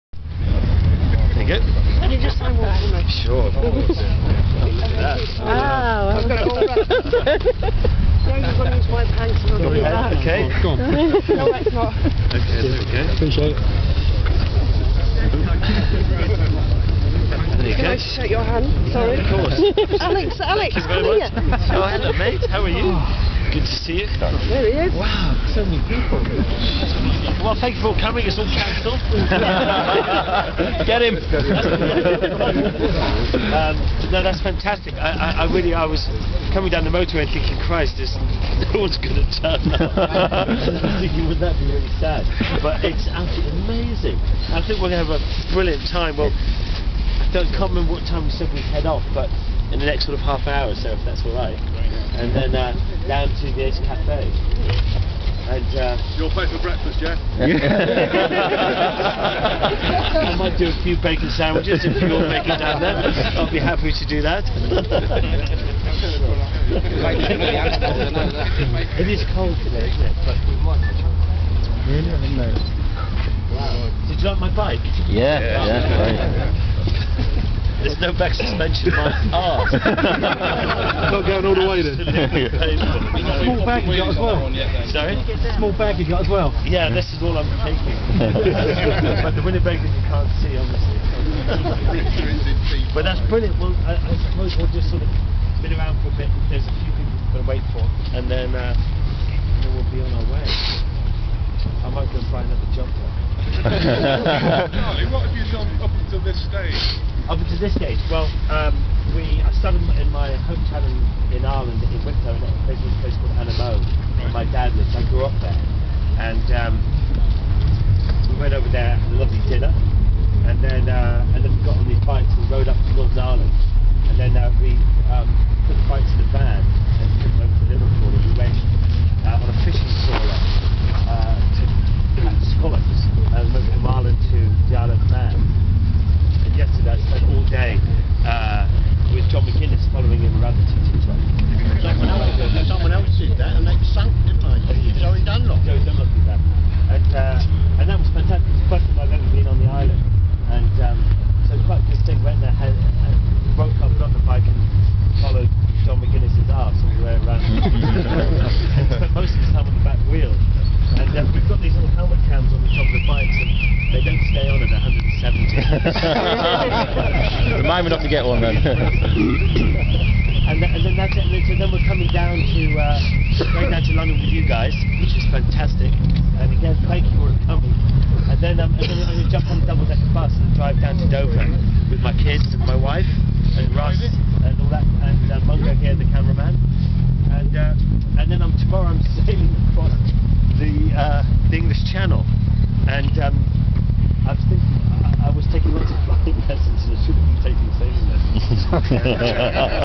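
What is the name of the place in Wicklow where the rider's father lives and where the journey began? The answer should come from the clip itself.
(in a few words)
Annamoe.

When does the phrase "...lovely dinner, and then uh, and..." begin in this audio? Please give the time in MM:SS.
01:59.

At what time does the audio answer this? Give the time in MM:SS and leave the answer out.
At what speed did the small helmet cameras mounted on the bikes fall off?
02:44.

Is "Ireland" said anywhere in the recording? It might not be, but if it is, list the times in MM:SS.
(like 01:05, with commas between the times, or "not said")
01:51, 02:03.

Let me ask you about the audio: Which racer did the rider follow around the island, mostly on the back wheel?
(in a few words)
John McGuinness.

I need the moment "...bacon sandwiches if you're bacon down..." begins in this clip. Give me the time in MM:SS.
01:01.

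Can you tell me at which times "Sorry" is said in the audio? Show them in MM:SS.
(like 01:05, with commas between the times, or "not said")
00:18, 01:24.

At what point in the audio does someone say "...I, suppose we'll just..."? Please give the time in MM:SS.
01:33.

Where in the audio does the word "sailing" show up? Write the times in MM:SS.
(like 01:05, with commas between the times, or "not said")
03:09, 03:17.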